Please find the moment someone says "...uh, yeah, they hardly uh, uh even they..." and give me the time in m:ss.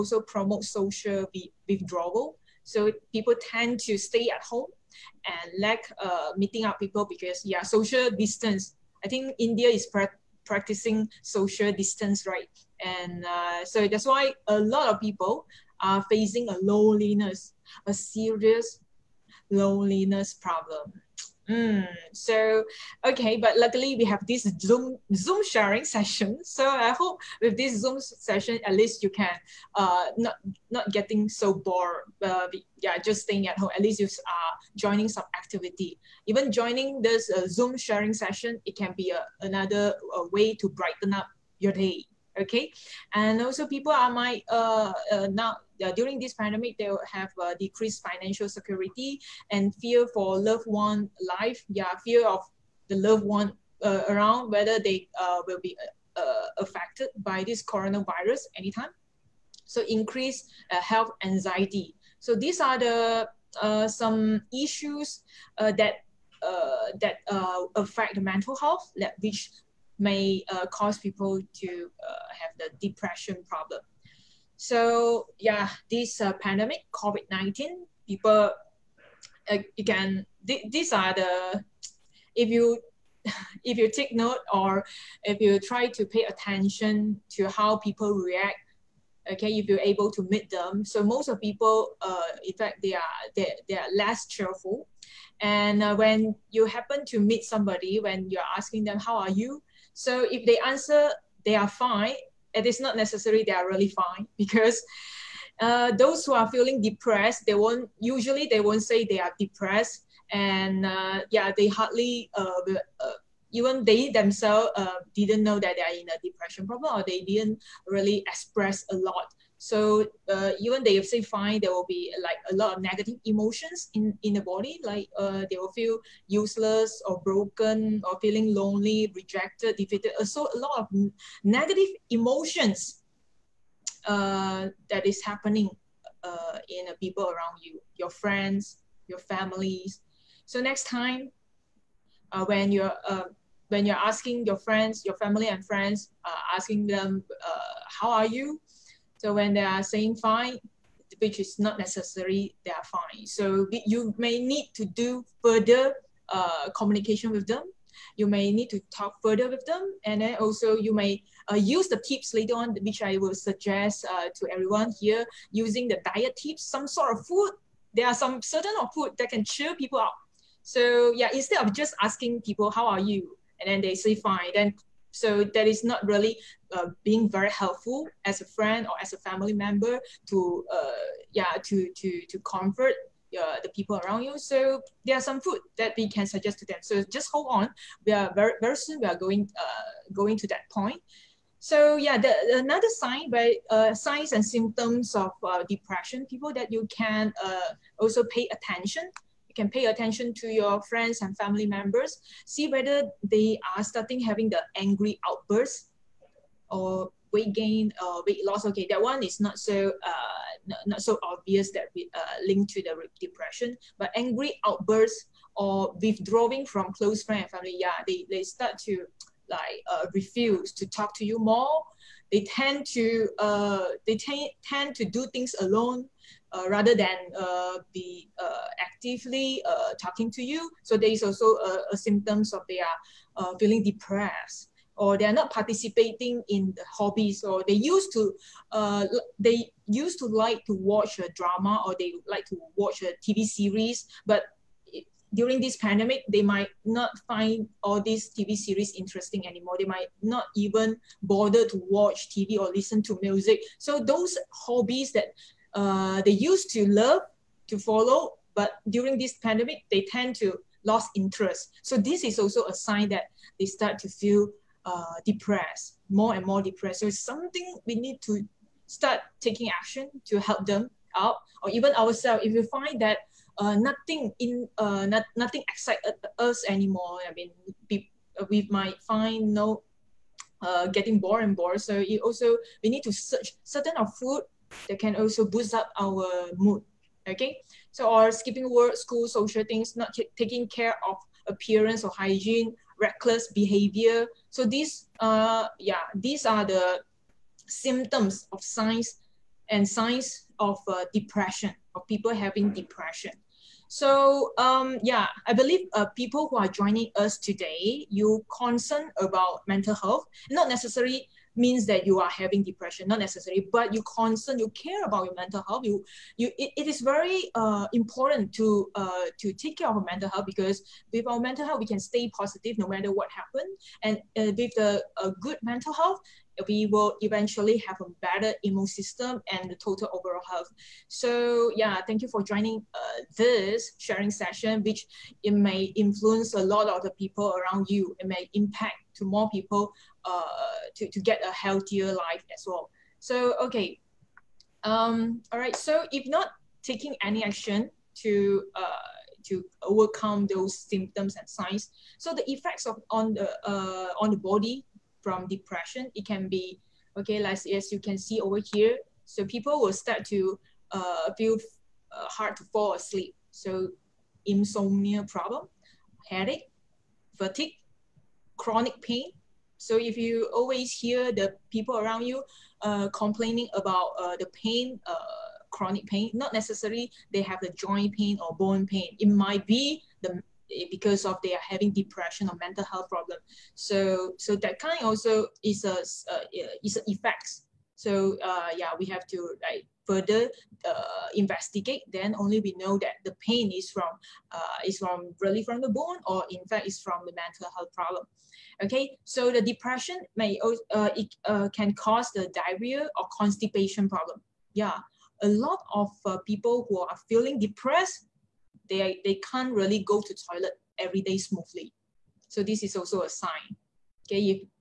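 1:50.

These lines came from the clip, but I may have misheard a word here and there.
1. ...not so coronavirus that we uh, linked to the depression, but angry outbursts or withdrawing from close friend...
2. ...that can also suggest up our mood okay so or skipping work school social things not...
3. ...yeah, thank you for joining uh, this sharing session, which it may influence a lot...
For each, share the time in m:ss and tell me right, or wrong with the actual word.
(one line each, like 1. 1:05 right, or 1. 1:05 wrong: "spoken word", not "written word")
1. 3:30 wrong: "obvious", not "coronavirus"
2. 4:44 wrong: "boost", not "suggest"
3. 5:31 right.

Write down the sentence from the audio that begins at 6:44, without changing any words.
Yeah, a lot of uh, people who are feeling depressed, they, they can't really go to toilet every day smoothly.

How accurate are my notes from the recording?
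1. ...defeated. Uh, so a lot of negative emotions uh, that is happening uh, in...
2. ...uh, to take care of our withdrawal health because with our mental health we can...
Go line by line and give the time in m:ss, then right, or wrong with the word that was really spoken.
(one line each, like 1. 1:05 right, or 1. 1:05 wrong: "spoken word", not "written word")
1. 2:09 right
2. 5:18 wrong: "mental", not "withdrawal".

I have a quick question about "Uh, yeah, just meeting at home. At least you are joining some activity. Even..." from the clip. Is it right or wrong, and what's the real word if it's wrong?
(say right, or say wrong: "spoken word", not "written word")
wrong: "staying", not "meeting".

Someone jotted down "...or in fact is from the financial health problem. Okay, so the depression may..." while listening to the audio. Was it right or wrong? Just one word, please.
wrong.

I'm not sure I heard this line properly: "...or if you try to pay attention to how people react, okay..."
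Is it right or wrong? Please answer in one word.
right.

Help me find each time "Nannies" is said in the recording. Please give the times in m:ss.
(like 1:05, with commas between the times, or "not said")
not said.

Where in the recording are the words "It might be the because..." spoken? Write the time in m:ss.
6:19.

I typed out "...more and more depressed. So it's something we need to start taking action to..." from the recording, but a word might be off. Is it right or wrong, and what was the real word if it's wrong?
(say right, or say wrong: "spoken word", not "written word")
right.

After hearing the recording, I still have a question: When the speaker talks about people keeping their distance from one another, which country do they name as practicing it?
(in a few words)
India.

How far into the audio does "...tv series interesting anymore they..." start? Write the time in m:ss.
4:08.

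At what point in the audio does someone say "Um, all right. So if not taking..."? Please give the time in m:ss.
5:44.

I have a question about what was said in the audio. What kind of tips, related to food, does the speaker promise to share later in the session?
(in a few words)
diet tips.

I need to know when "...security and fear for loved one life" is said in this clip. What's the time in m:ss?
0:48.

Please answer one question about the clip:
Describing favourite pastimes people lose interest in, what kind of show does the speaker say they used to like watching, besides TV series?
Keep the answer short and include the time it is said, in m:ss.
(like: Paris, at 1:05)
drama, at 4:01.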